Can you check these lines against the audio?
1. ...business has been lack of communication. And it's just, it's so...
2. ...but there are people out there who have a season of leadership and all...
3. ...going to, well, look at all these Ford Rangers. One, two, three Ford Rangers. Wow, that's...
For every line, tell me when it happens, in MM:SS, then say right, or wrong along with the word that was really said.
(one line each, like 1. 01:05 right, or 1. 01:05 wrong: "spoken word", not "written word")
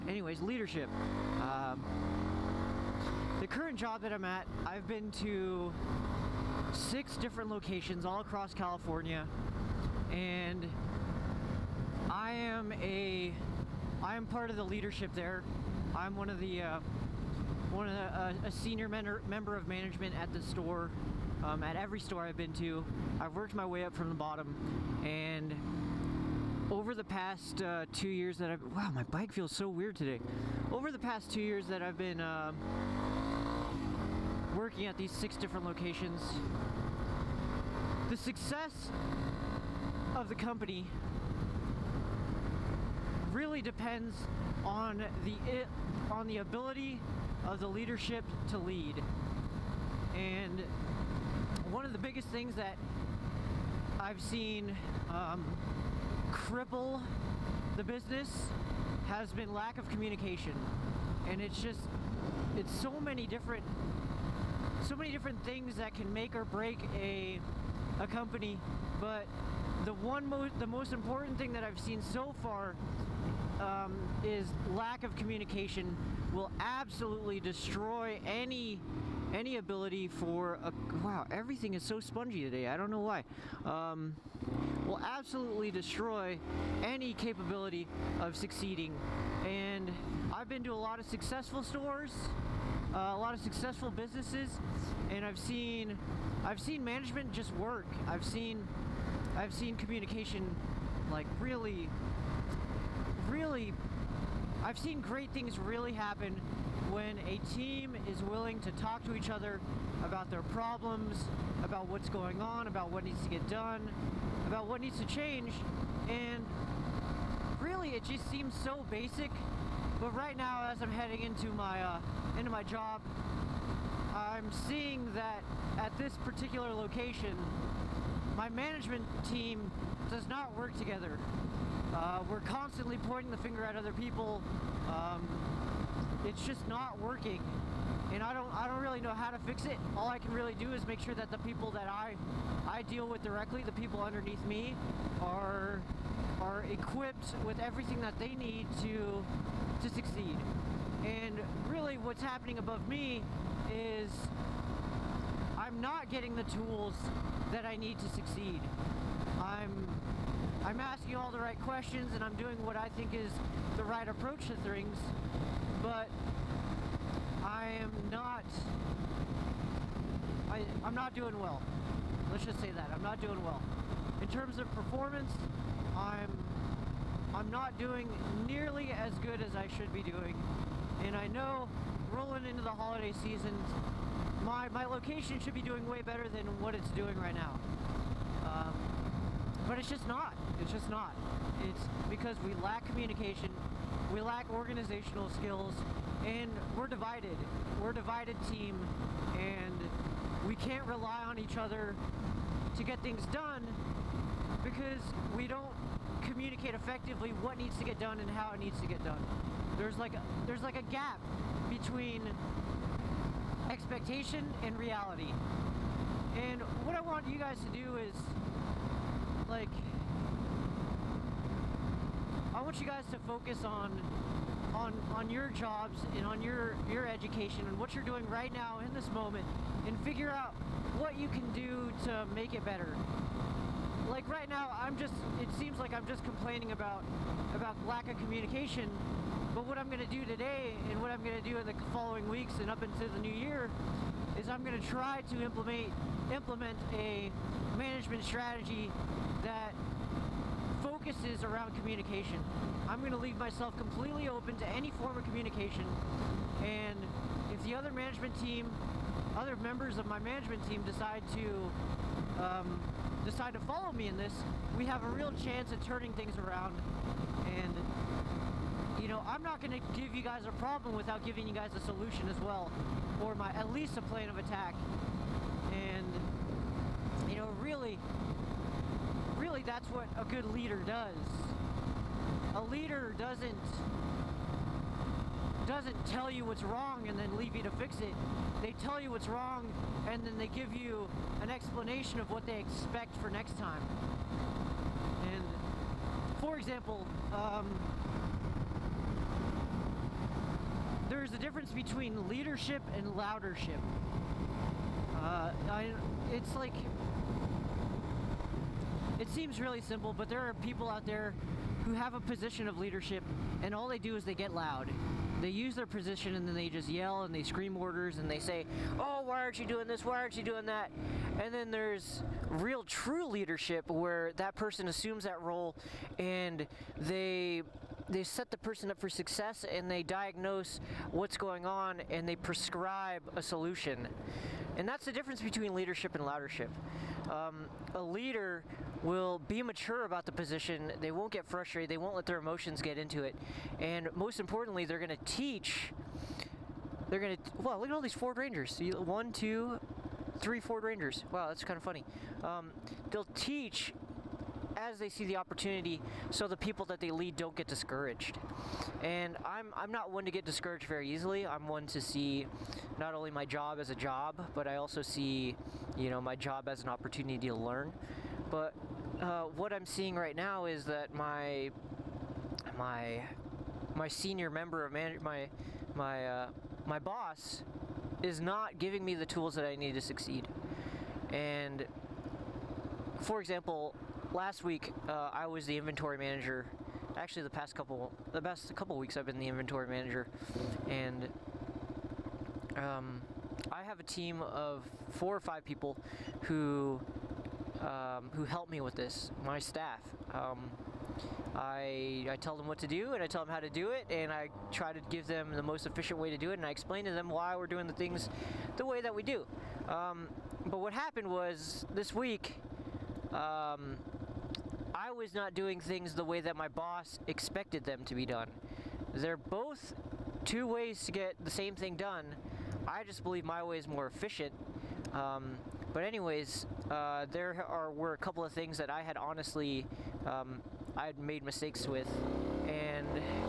1. 00:57 right
2. 05:10 wrong: "position", not "season"
3. 05:47 right.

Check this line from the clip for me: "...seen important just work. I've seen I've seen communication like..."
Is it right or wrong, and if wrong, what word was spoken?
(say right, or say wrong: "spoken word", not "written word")
wrong: "management", not "important".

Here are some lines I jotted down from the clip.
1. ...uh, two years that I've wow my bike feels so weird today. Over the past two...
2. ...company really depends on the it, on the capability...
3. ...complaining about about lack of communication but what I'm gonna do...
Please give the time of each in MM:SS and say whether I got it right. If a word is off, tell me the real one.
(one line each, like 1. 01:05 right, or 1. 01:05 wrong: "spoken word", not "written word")
1. 00:27 right
2. 00:40 wrong: "ability", not "capability"
3. 03:56 right.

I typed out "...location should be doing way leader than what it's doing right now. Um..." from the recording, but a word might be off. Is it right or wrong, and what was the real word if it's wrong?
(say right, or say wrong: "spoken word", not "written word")
wrong: "better", not "leader".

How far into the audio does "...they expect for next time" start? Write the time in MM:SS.
04:52.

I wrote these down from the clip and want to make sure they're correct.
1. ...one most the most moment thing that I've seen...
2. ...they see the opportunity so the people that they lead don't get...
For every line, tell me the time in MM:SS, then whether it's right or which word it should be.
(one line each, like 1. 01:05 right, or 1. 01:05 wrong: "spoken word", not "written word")
1. 01:09 wrong: "important", not "moment"
2. 05:54 right.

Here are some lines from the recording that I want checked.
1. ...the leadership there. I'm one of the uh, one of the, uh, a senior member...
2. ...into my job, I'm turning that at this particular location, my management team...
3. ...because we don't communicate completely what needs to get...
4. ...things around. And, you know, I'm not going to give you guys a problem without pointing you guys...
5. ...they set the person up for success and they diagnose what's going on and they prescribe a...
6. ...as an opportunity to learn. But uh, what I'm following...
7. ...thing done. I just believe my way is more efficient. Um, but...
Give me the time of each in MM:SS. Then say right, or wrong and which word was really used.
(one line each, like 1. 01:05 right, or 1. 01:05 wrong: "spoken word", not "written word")
1. 00:14 right
2. 02:02 wrong: "seeing", not "turning"
3. 03:24 wrong: "effectively", not "completely"
4. 04:26 wrong: "giving", not "pointing"
5. 05:28 right
6. 06:06 wrong: "seeing", not "following"
7. 07:01 right.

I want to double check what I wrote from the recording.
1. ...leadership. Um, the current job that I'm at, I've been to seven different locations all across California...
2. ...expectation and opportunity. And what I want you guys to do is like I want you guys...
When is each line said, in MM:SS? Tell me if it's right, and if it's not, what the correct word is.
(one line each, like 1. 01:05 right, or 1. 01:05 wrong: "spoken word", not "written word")
1. 00:00 wrong: "six", not "seven"
2. 03:33 wrong: "reality", not "opportunity".